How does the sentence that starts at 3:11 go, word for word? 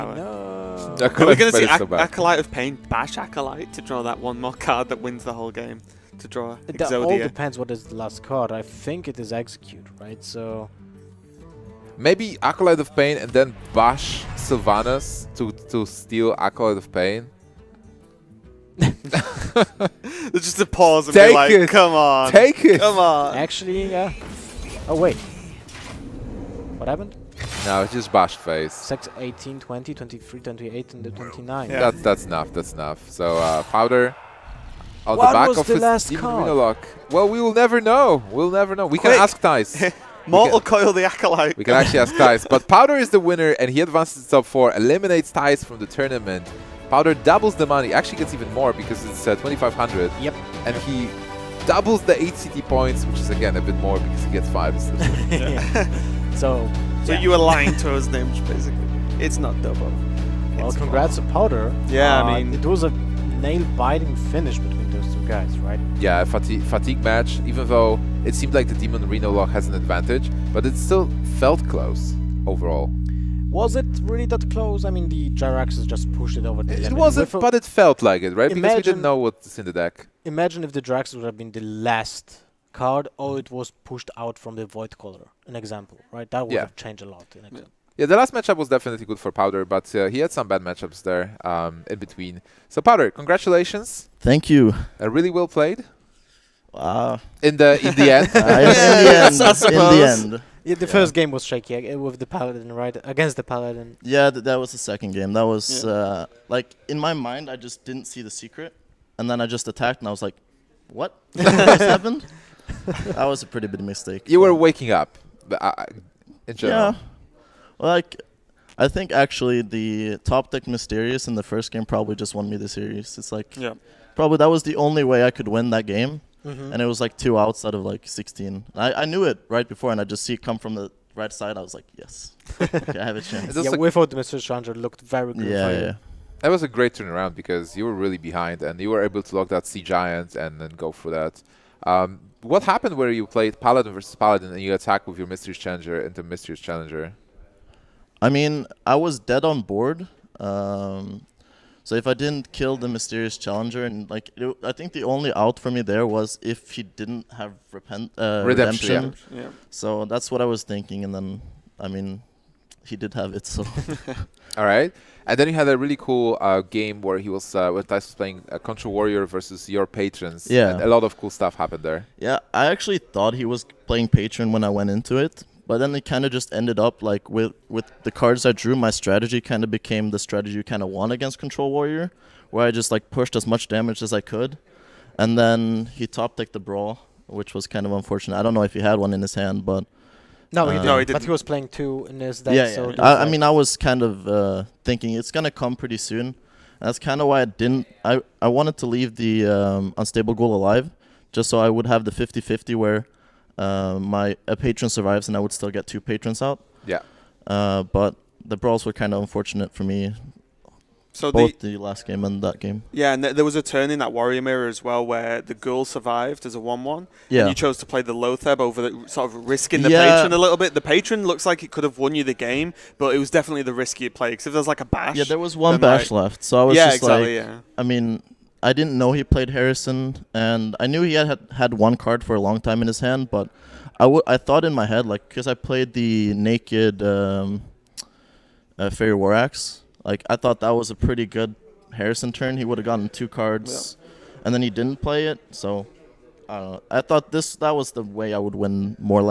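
But he was playing two in his deck.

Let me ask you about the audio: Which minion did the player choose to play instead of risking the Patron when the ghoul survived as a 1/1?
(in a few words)
Loatheb.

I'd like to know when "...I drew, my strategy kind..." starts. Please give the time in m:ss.
2:58.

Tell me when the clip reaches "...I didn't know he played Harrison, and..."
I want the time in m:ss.
3:48.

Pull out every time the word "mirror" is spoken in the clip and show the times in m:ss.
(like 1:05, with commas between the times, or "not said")
3:34.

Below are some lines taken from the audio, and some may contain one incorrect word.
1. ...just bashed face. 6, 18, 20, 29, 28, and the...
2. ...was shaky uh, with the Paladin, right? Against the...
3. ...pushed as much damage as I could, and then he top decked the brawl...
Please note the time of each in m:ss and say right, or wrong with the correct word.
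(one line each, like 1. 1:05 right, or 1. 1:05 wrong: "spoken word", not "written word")
1. 0:27 wrong: "23", not "29"
2. 1:41 right
3. 3:03 right.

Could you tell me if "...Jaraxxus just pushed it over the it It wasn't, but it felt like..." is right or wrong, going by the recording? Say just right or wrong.
right.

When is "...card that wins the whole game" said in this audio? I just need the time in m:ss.
0:04.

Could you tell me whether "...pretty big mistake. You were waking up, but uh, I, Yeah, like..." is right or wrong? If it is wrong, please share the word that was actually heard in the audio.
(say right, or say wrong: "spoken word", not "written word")
right.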